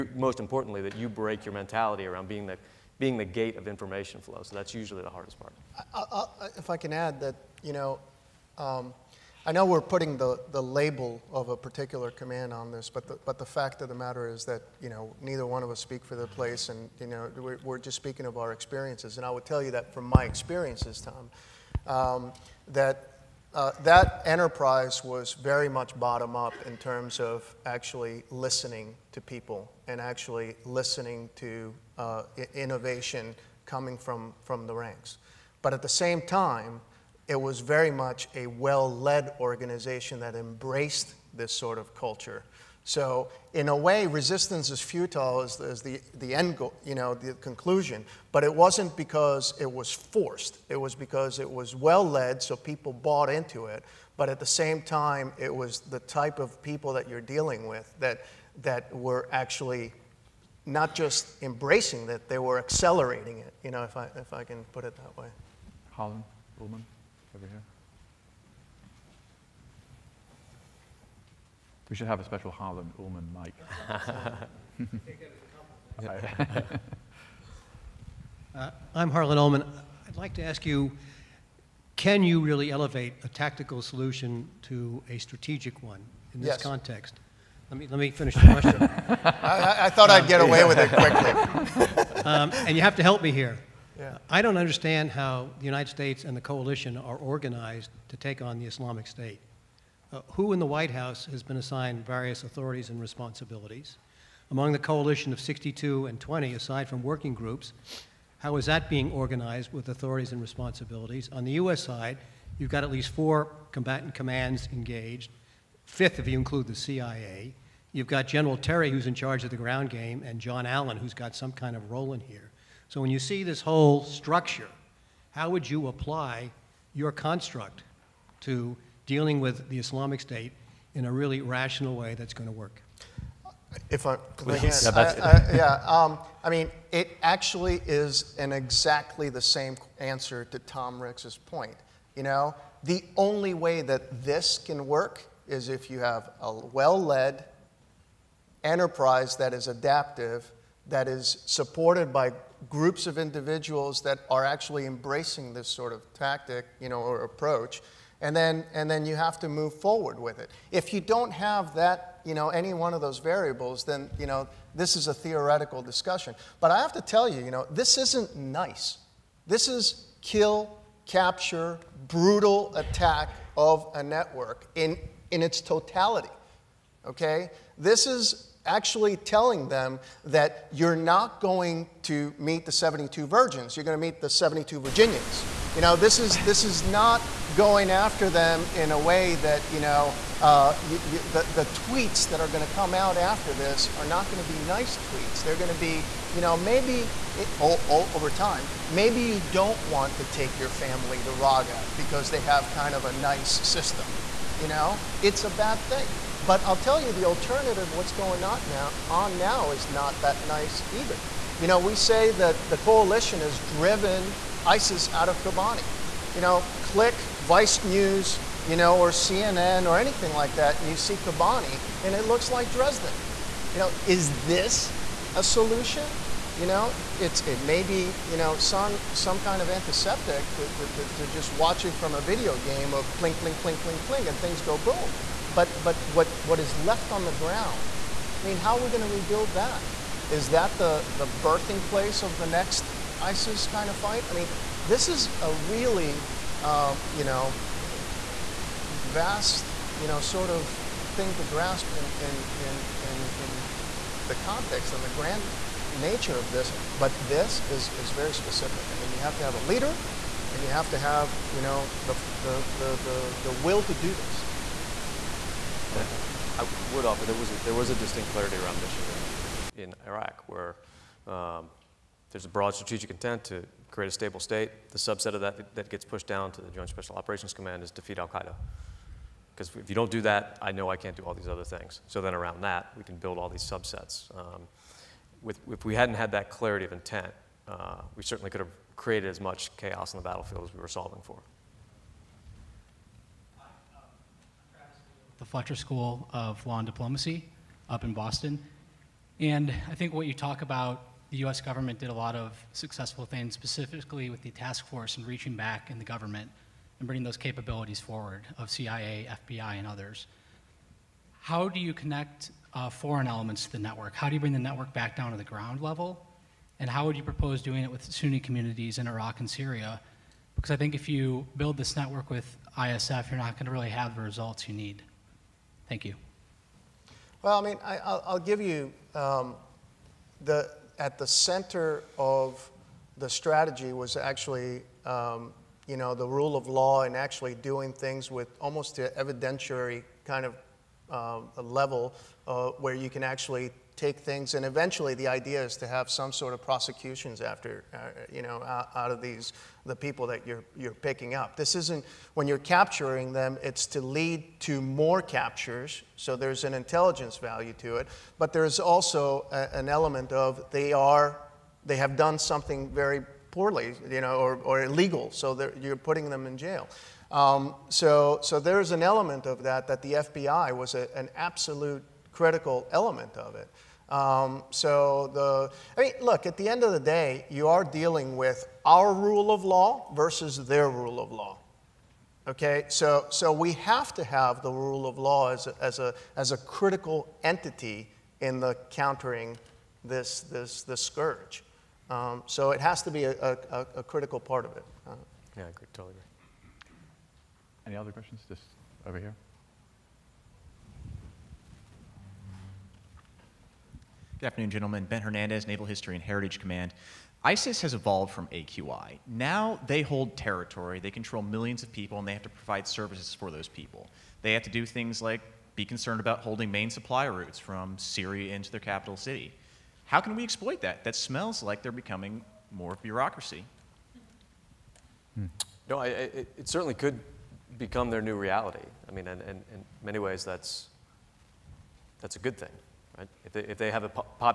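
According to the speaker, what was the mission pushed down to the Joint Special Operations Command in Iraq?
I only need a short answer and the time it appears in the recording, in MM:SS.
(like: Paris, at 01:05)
defeat Al Qaeda, at 04:37.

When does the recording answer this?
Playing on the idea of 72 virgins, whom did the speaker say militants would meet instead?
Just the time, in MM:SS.
03:04.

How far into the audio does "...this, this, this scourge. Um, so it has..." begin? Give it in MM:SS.
06:30.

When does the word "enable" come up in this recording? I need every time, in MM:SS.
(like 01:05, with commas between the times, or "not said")
not said.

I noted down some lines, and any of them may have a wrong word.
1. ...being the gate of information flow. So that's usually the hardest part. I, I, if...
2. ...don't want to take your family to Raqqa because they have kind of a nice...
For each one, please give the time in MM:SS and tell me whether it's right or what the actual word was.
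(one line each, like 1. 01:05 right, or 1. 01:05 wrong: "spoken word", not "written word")
1. 00:02 right
2. 03:19 right.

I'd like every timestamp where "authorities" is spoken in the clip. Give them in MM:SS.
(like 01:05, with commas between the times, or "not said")
01:42, 01:49.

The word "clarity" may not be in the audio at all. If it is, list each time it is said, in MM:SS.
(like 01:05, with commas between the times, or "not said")
04:28, 04:46.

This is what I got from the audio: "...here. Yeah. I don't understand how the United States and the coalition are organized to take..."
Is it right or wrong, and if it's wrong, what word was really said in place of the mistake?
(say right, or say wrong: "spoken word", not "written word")
right.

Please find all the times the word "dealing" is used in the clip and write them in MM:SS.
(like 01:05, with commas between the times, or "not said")
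00:57, 02:09, 06:17.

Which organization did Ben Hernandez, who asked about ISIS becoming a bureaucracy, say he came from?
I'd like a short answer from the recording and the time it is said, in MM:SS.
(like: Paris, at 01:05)
Naval History and Heritage Command, at 06:45.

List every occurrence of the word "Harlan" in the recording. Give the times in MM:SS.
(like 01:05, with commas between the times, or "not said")
01:05, 01:12, 01:19.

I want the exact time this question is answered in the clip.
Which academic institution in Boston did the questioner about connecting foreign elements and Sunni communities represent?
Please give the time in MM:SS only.
04:55.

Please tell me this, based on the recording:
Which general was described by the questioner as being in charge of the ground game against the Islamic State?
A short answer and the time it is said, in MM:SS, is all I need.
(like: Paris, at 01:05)
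General Terry, at 01:58.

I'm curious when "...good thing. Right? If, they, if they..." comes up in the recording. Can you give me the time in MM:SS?
07:12.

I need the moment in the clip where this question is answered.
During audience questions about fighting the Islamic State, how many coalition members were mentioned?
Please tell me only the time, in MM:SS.
01:45.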